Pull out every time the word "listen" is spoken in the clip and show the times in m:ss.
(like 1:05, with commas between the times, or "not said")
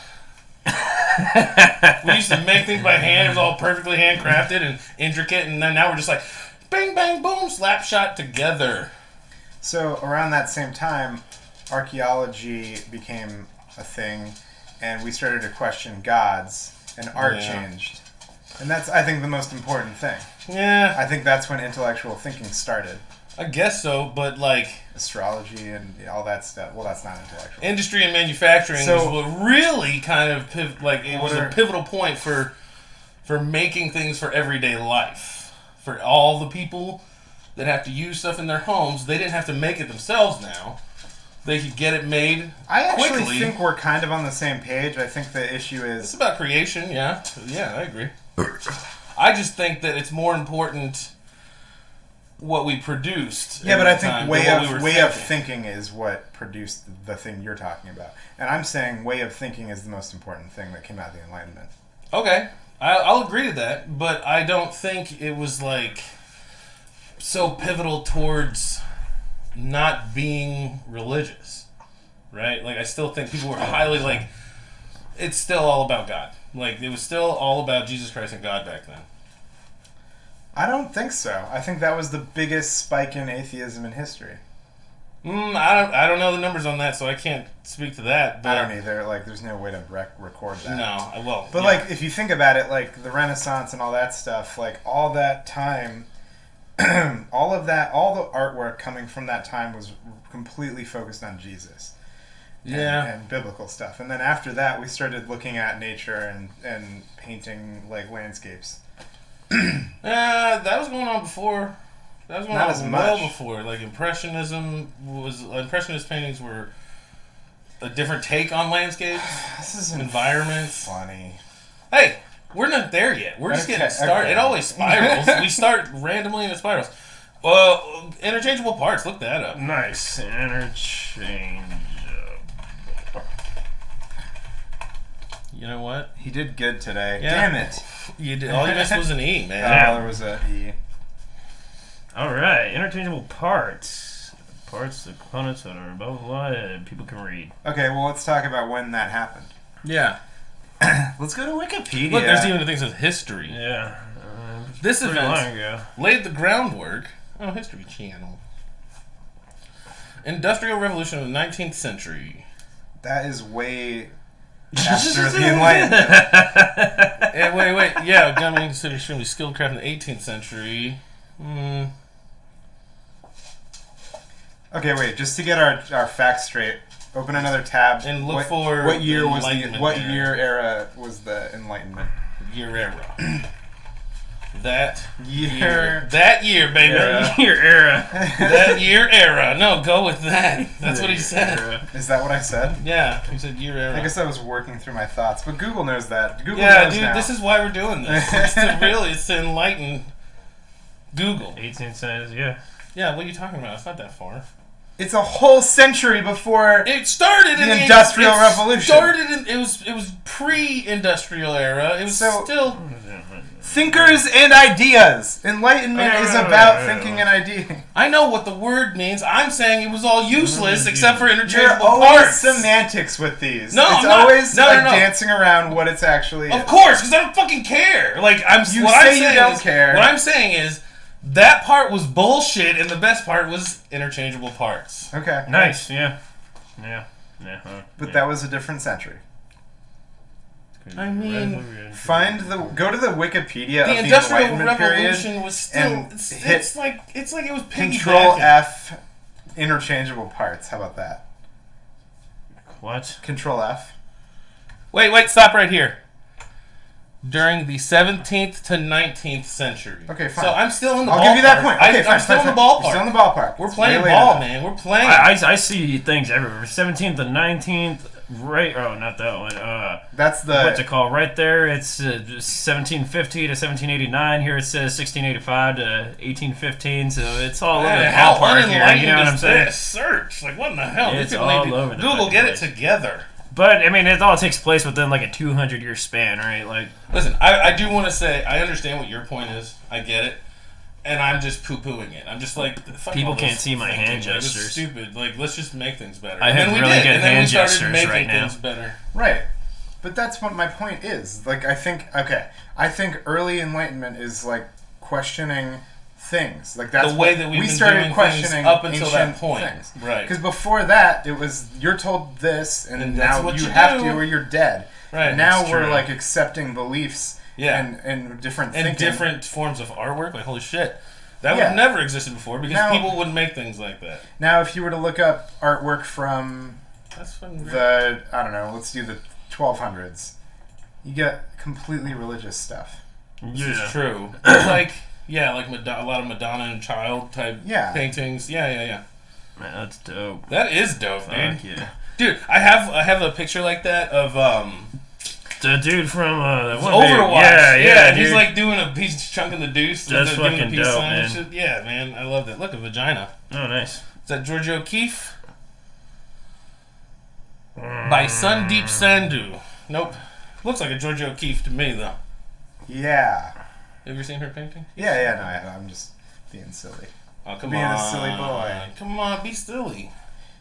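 4:47.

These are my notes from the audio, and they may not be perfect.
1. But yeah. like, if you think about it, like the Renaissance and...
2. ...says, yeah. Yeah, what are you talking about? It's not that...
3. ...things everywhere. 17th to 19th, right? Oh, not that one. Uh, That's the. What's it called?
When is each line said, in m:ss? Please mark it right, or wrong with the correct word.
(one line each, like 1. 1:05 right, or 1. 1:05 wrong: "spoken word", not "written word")
1. 1:31 right
2. 3:21 right
3. 4:25 right.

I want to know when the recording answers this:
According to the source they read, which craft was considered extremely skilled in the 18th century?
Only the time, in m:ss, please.
2:48.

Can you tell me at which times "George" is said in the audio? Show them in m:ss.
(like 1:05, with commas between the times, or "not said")
5:54, 6:00.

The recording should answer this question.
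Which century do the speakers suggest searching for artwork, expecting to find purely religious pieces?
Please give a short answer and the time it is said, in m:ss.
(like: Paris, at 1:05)
1200s, at 5:29.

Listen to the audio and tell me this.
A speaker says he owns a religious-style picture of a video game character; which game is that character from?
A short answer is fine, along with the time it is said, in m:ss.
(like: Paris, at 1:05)
Overwatch, at 5:46.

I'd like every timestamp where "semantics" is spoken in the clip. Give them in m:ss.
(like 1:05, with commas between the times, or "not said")
3:42.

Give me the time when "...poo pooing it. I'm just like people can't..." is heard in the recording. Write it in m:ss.
4:51.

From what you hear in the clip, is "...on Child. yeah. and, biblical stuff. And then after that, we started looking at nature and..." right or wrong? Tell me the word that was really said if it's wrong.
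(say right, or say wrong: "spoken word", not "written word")
wrong: "Jesus", not "Child".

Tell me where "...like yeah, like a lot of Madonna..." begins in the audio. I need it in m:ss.
5:34.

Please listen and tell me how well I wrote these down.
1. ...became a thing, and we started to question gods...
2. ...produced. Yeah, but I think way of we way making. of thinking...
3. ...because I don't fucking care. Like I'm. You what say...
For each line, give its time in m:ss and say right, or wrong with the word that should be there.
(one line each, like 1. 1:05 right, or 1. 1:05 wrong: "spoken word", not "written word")
1. 0:12 right
2. 0:52 wrong: "thinking", not "making"
3. 3:47 right.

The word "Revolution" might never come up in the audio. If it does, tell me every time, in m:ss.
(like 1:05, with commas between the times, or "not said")
2:40, 3:28, 4:04.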